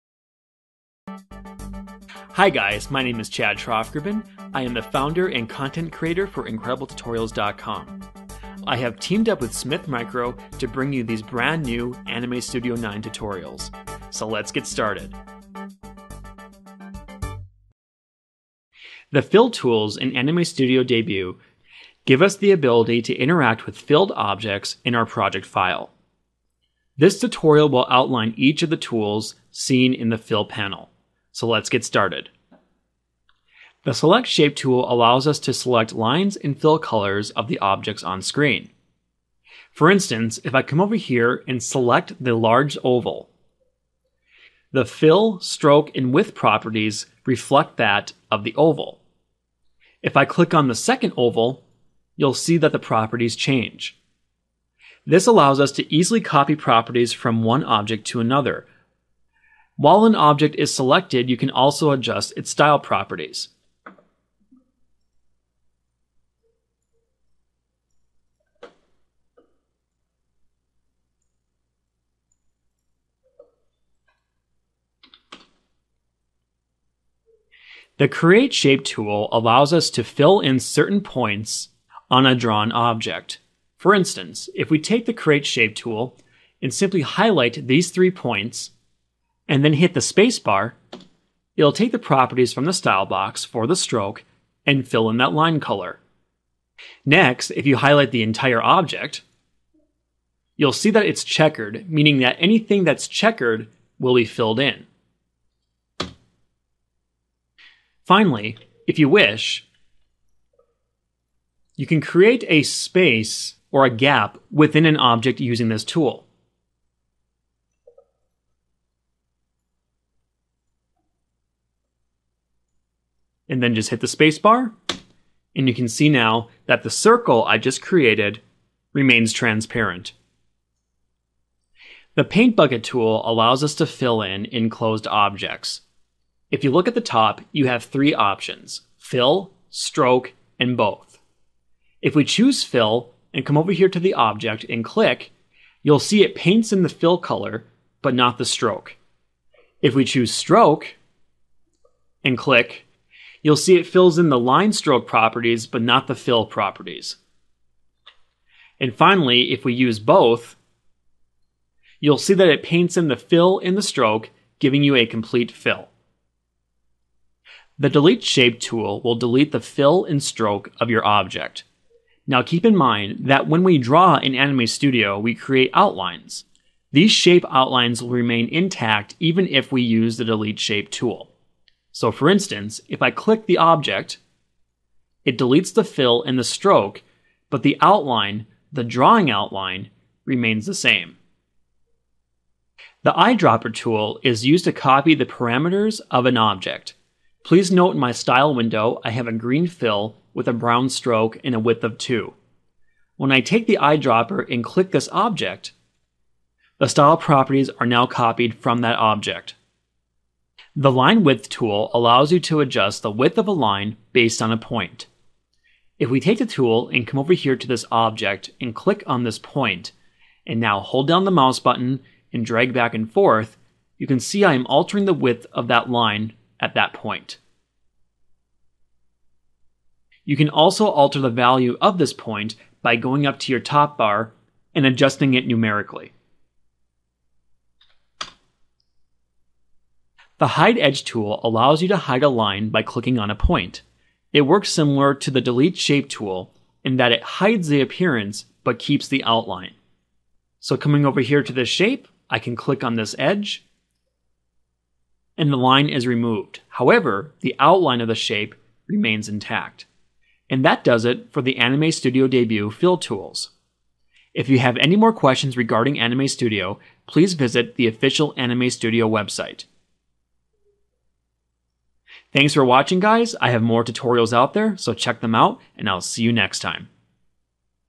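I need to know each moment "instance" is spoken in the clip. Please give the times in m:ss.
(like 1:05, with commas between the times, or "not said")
0:39, 1:23, 3:02.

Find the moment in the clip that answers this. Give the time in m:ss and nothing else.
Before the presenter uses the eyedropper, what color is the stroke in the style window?
3:20.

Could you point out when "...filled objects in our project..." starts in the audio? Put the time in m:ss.
0:23.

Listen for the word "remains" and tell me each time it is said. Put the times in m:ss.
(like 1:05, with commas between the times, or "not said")
2:08, 2:58, 3:10, 4:18.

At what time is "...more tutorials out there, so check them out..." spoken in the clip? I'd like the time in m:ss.
4:33.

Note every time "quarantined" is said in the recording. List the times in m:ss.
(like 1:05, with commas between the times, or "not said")
not said.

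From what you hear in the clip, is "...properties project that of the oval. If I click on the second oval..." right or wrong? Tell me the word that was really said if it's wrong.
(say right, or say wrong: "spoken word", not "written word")
wrong: "reflect", not "project".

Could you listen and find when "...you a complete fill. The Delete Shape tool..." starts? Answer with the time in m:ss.
2:44.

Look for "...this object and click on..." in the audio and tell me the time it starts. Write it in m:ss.
3:37.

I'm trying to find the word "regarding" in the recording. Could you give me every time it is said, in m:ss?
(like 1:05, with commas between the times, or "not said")
4:25.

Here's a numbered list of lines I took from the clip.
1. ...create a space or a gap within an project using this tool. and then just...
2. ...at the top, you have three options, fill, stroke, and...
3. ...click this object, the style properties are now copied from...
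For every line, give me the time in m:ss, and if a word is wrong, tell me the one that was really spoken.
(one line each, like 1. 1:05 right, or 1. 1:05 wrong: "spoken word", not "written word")
1. 1:51 wrong: "object", not "project"
2. 2:16 right
3. 3:24 right.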